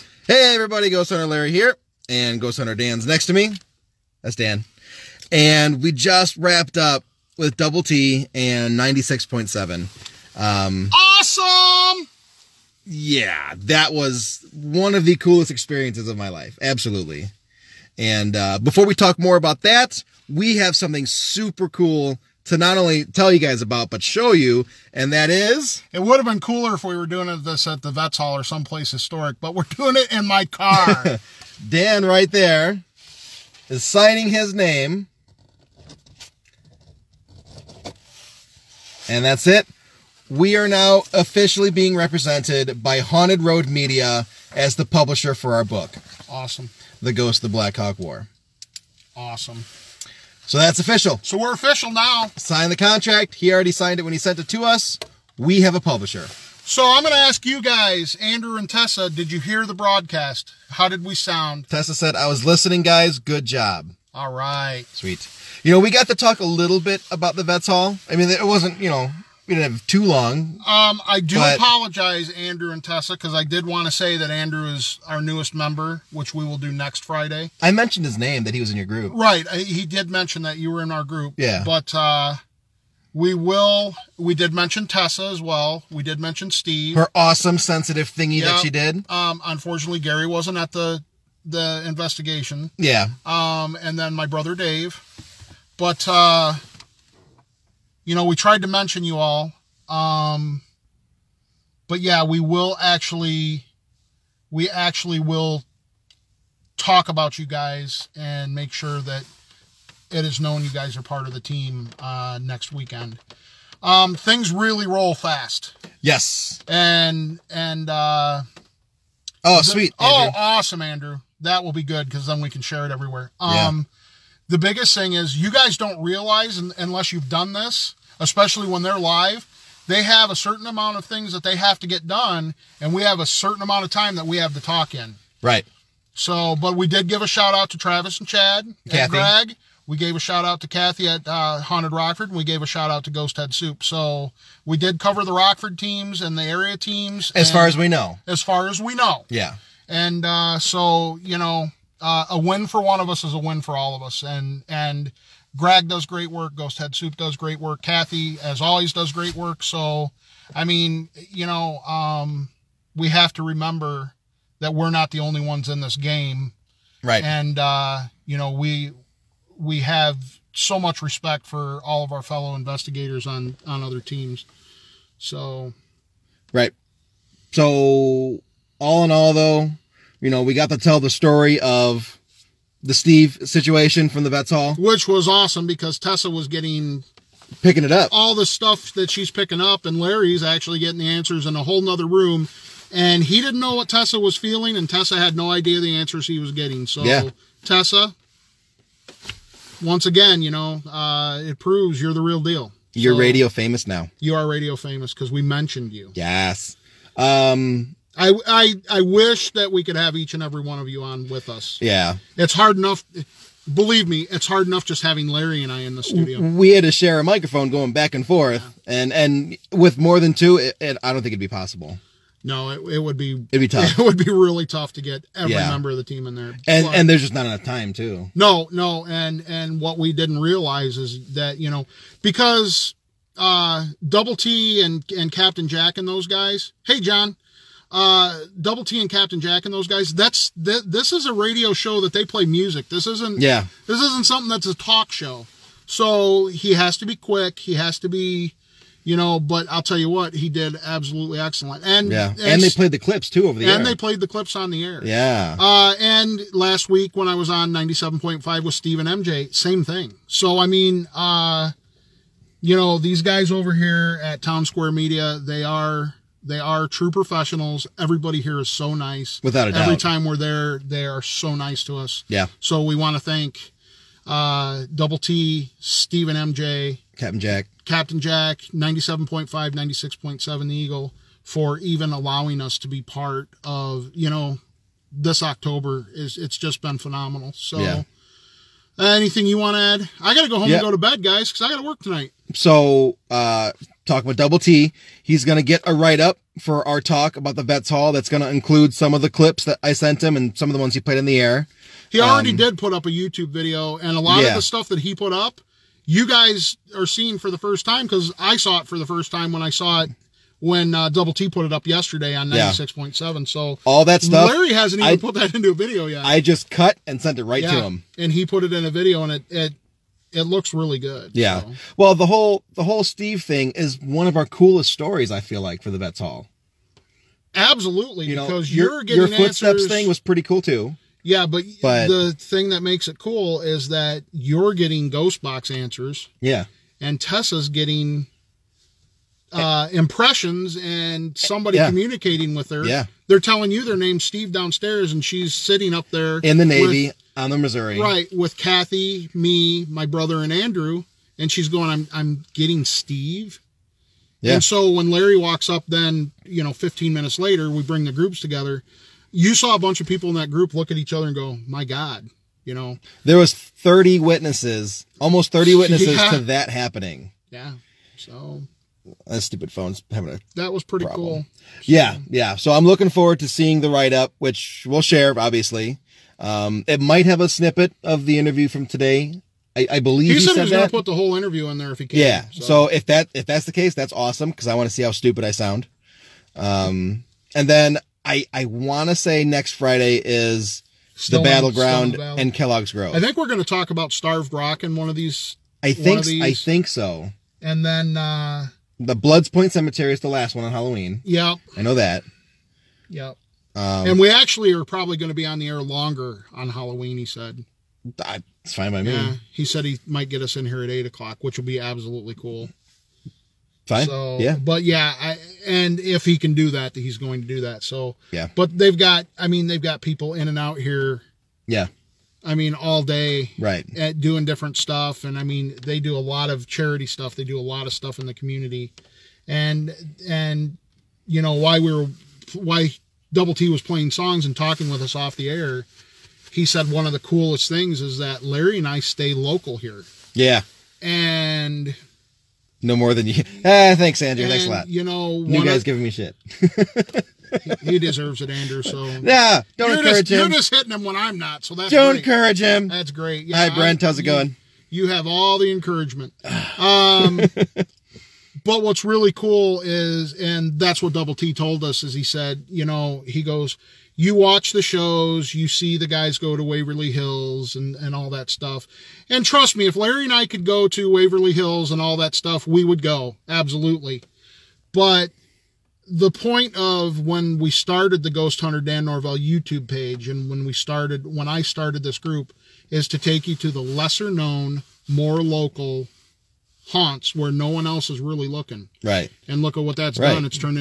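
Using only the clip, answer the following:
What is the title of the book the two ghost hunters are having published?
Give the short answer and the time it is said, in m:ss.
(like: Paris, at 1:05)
The Ghost of the Black Hawk War, at 0:47.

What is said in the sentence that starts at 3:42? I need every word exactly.
No, it, it would be it'd be tough.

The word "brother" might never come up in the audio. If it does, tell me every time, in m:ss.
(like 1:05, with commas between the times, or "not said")
1:34, 5:50.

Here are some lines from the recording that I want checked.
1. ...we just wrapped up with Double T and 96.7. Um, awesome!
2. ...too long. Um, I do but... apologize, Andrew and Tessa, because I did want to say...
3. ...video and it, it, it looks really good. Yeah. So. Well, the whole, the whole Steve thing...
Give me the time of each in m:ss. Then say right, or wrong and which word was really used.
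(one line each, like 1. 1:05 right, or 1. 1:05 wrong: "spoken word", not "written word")
1. 0:05 right
2. 1:09 right
3. 5:18 right.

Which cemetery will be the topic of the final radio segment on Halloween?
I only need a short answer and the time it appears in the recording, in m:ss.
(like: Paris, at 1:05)
Bloods Point Cemetery, at 6:39.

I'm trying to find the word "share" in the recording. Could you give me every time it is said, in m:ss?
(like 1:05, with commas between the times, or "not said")
2:02, 3:36, 6:15.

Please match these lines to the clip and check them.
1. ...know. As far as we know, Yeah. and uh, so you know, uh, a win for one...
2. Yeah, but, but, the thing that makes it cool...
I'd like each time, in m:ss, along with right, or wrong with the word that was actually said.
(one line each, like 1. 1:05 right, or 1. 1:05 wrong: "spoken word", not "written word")
1. 2:27 right
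2. 5:31 right.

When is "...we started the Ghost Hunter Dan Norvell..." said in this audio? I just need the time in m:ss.
7:57.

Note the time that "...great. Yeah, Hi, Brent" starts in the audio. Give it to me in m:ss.
7:33.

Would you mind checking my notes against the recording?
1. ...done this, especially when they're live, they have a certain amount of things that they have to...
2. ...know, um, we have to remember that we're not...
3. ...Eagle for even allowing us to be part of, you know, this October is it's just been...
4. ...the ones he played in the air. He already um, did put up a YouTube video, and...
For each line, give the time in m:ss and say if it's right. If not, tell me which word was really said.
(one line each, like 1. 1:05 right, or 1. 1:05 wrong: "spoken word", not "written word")
1. 2:07 right
2. 2:41 right
3. 4:40 right
4. 5:00 right.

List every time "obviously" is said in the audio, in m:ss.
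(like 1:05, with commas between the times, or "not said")
6:15.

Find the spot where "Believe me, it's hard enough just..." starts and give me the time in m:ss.
3:33.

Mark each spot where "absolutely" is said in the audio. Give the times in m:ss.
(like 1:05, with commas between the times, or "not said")
0:16, 4:10, 5:27, 6:51, 7:53.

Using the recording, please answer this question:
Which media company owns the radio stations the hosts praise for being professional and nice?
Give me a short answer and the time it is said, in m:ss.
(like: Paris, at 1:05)
Town Square Media, at 4:24.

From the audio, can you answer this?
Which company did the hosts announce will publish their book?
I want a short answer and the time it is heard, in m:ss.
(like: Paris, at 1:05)
Haunted Road Media, at 0:43.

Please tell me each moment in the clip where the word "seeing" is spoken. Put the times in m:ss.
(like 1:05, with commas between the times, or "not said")
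5:07, 6:13.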